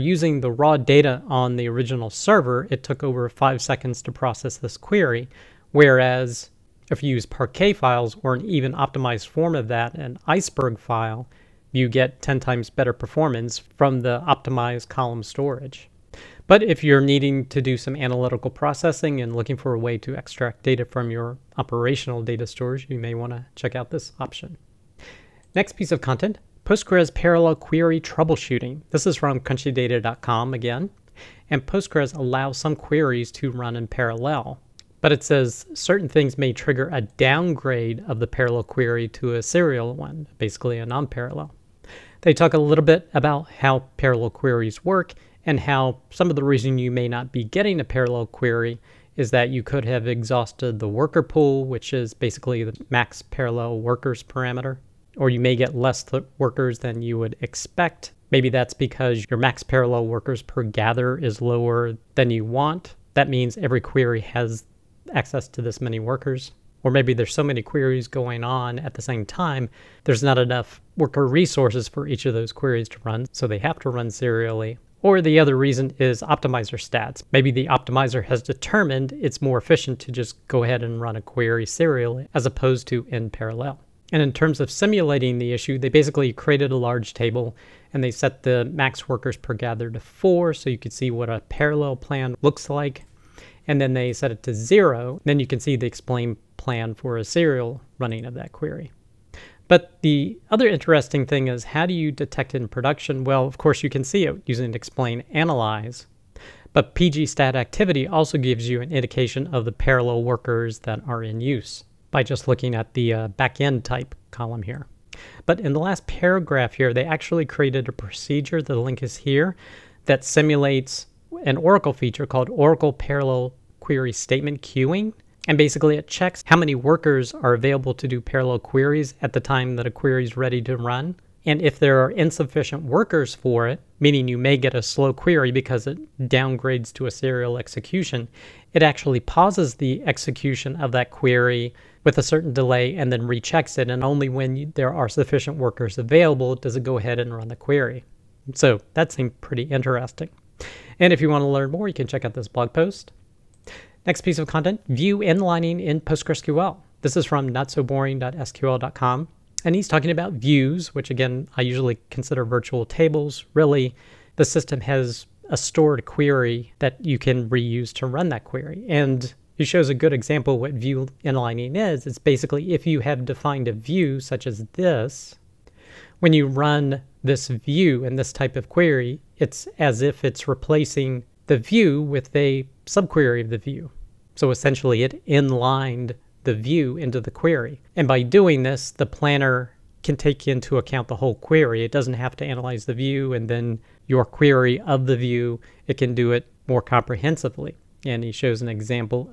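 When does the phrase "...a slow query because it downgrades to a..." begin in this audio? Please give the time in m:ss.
2:14.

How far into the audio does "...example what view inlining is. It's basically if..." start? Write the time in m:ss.
2:50.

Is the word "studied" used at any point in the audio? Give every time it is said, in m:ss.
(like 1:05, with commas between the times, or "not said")
not said.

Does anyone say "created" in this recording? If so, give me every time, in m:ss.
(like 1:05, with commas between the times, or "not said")
1:26, 1:57.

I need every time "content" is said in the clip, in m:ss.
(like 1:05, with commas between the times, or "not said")
0:26, 2:34.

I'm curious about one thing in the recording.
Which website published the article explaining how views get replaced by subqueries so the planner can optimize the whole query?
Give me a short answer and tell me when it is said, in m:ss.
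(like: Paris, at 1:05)
notsoboringsql.com, at 2:37.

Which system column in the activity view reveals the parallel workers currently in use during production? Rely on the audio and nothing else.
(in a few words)
backend type.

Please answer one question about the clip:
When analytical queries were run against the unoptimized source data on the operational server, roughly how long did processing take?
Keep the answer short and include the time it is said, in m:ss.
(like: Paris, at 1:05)
over 5 seconds, at 0:03.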